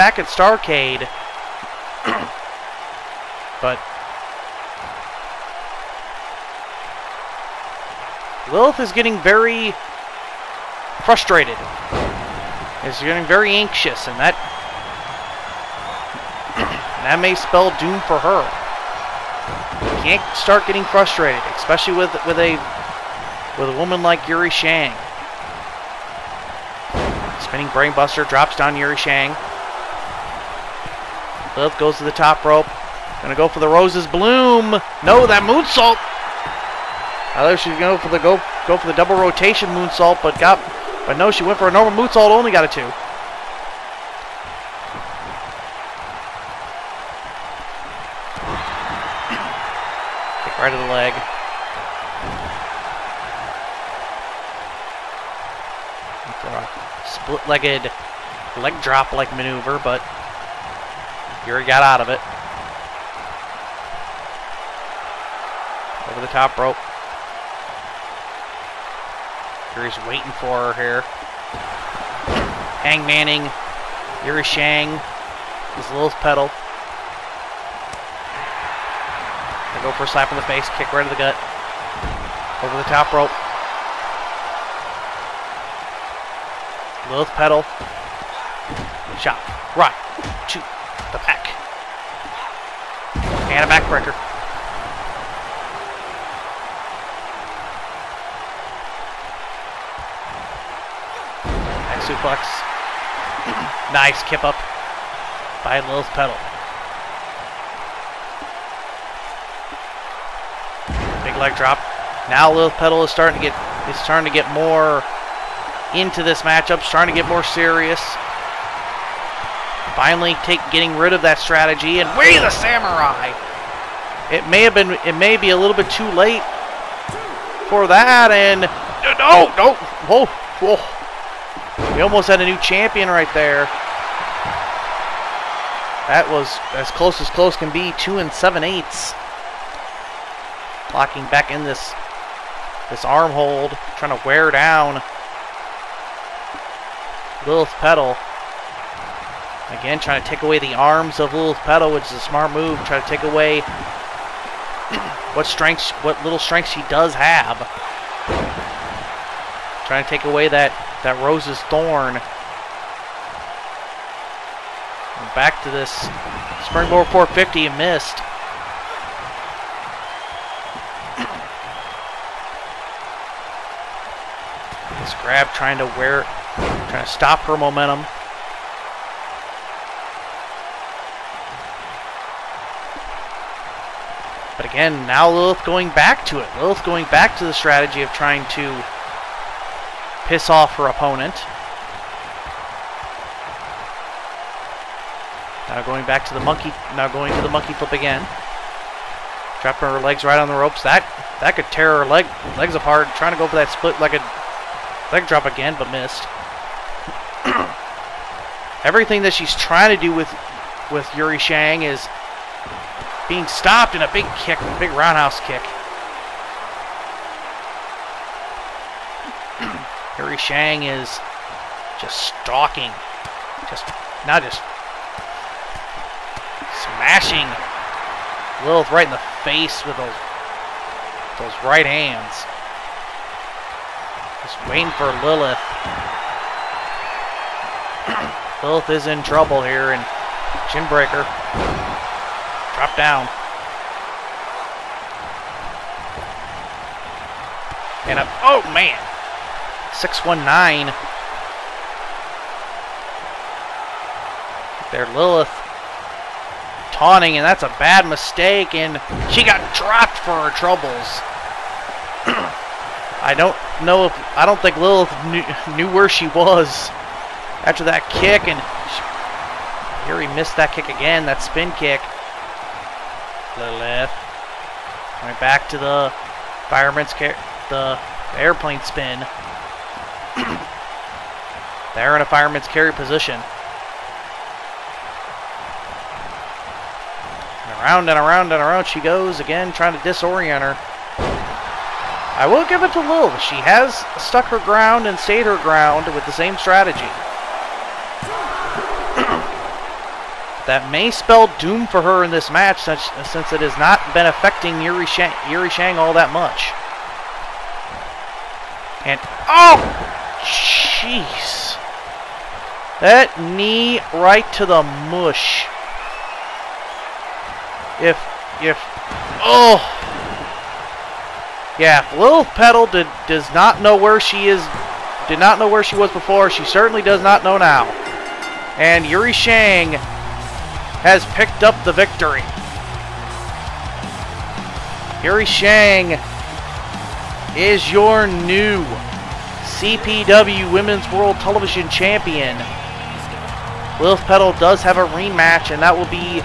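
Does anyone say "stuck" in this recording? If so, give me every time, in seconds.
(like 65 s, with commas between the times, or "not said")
294 s.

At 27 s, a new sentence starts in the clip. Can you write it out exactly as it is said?
Spinning brainbuster drops down Yuri Shang.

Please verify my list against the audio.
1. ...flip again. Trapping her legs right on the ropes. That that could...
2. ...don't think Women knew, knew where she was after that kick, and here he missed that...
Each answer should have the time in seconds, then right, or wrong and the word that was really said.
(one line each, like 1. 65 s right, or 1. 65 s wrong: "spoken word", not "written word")
1. 197 s right
2. 264 s wrong: "Lilith", not "Women".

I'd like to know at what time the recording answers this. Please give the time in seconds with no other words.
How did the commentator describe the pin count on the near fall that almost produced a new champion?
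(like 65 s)
137 s.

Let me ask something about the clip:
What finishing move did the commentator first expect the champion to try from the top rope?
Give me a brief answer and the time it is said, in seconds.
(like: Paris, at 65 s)
Roses Bloom, at 33 s.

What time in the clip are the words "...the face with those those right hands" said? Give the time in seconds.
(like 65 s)
229 s.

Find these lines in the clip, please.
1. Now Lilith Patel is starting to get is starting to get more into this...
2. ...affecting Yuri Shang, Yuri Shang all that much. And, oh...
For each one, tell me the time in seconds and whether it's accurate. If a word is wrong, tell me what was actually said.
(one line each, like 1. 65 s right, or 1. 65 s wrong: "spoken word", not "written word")
1. 112 s right
2. 304 s right.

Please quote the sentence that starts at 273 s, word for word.
Lilith went back to the fireman's care, the airplane spin.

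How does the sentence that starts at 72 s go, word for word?
Hang Manning, Yuri Shang, his little Patel.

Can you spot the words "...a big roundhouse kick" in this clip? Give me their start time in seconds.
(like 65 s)
214 s.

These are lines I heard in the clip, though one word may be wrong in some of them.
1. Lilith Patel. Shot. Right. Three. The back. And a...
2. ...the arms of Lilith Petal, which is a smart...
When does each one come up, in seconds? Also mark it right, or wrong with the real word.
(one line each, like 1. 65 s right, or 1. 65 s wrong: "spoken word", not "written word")
1. 87 s wrong: "Two", not "Three"
2. 150 s right.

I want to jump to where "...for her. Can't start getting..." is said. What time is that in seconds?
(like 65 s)
18 s.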